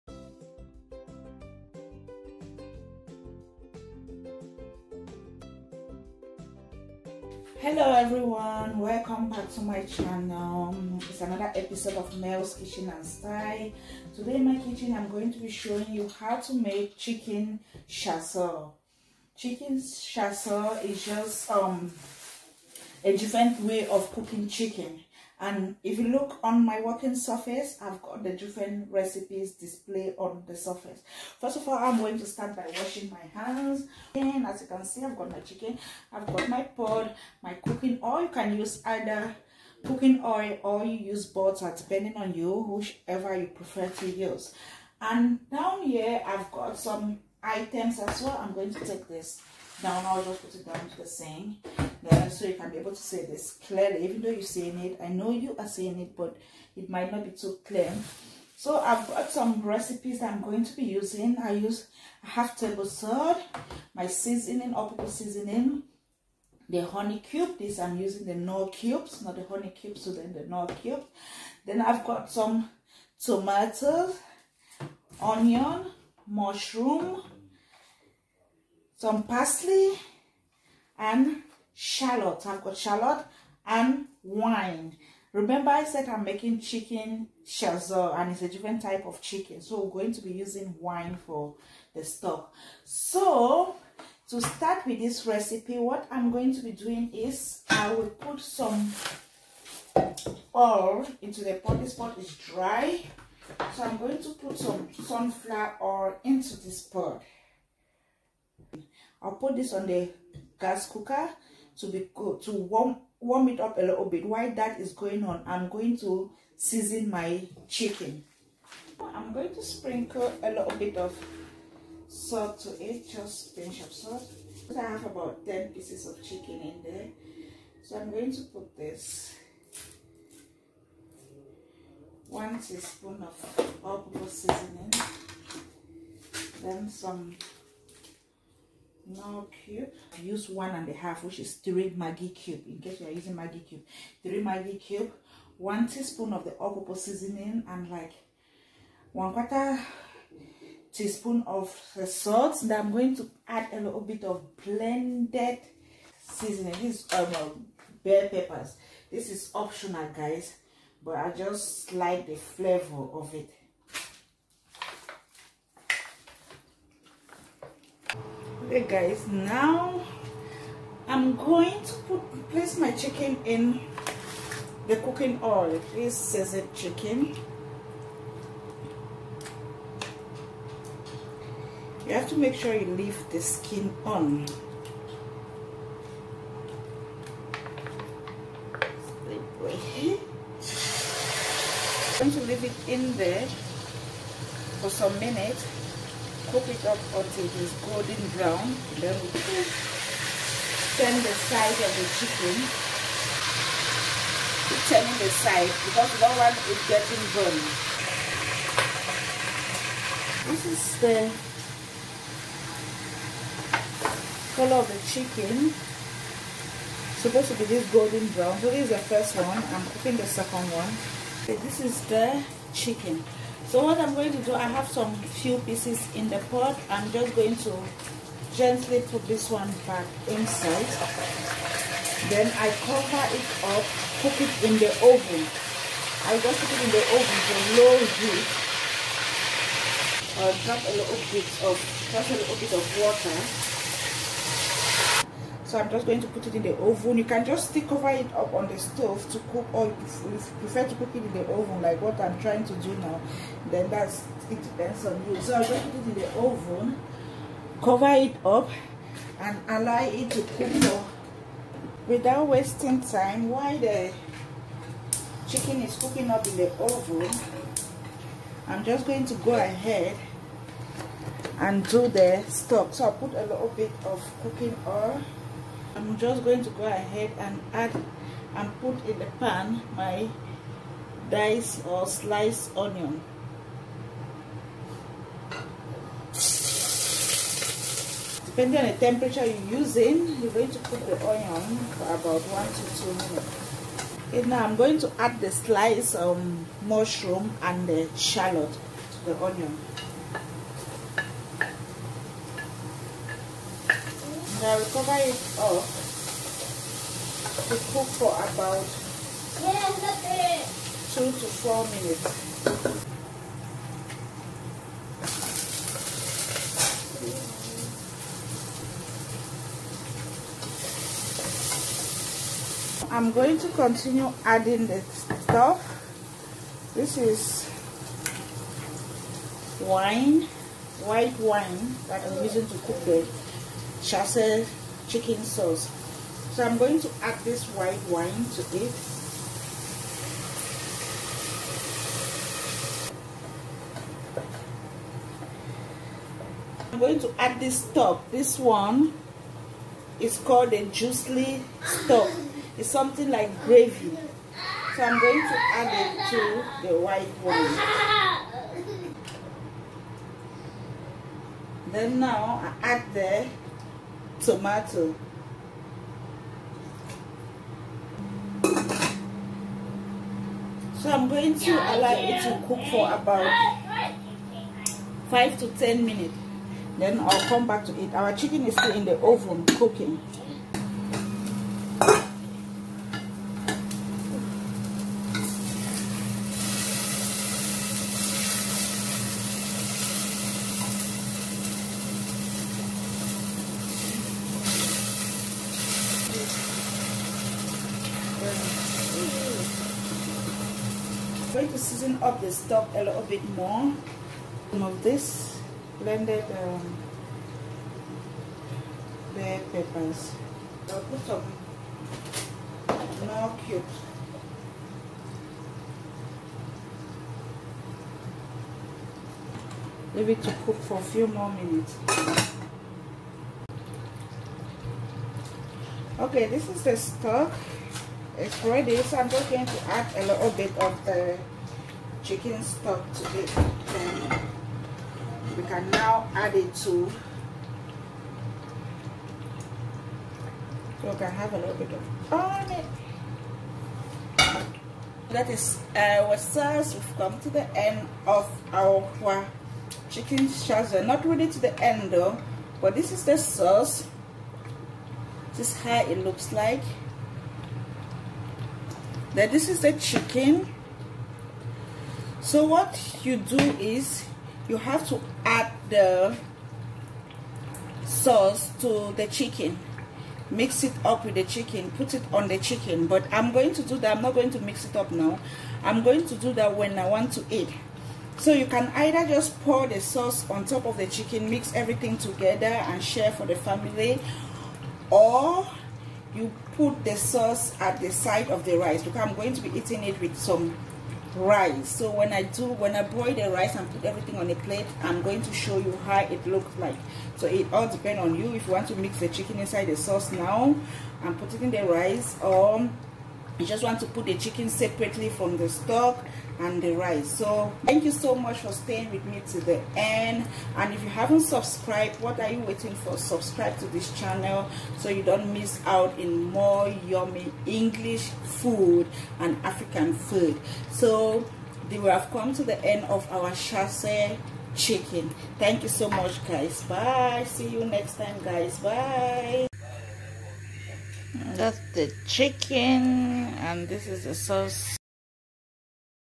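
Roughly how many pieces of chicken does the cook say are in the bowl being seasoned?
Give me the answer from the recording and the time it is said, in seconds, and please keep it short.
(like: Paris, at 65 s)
10, at 125 s.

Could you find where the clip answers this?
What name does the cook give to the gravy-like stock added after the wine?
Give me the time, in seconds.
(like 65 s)
350 s.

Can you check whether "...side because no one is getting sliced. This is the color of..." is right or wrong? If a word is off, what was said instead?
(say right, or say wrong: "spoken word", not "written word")
wrong: "burned", not "sliced".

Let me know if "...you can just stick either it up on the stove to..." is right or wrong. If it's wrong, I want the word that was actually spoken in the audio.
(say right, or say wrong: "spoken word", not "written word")
wrong: "cover", not "either".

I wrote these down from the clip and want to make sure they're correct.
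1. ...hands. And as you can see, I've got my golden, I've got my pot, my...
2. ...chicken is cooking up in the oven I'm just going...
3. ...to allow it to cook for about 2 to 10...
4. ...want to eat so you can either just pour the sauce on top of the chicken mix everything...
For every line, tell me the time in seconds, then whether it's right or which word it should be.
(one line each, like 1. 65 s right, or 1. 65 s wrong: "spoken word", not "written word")
1. 33 s wrong: "chicken", not "golden"
2. 265 s right
3. 371 s wrong: "5", not "2"
4. 477 s right.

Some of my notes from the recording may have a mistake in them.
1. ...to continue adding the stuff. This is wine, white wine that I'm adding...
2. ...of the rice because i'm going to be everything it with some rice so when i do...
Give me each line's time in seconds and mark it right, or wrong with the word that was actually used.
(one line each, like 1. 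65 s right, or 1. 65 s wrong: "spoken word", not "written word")
1. 323 s wrong: "using", not "adding"
2. 488 s wrong: "eating", not "everything".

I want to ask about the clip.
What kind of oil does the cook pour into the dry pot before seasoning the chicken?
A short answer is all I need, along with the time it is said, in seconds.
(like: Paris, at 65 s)
sunflower oil, at 104 s.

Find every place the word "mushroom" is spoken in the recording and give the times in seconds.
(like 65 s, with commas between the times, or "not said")
76 s, 296 s.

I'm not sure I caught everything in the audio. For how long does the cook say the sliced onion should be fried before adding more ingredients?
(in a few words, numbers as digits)
1 to 2 minutes.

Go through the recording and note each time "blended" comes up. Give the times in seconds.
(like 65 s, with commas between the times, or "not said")
154 s, 405 s.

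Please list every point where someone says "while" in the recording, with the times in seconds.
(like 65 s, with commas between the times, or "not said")
114 s, 263 s.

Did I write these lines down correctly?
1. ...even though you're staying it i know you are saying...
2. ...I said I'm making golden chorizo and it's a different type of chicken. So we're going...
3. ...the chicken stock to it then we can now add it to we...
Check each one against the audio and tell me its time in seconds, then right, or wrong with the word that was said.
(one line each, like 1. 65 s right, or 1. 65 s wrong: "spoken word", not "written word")
1. 54 s wrong: "saying", not "staying"
2. 85 s wrong: "chicken", not "golden"
3. 431 s right.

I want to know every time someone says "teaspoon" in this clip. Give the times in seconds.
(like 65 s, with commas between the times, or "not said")
132 s, 145 s, 150 s.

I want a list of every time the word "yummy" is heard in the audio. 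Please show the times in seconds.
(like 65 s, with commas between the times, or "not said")
517 s.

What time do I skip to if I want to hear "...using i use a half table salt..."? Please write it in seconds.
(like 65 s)
60 s.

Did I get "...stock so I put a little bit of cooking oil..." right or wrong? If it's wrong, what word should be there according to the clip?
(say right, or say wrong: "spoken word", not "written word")
right.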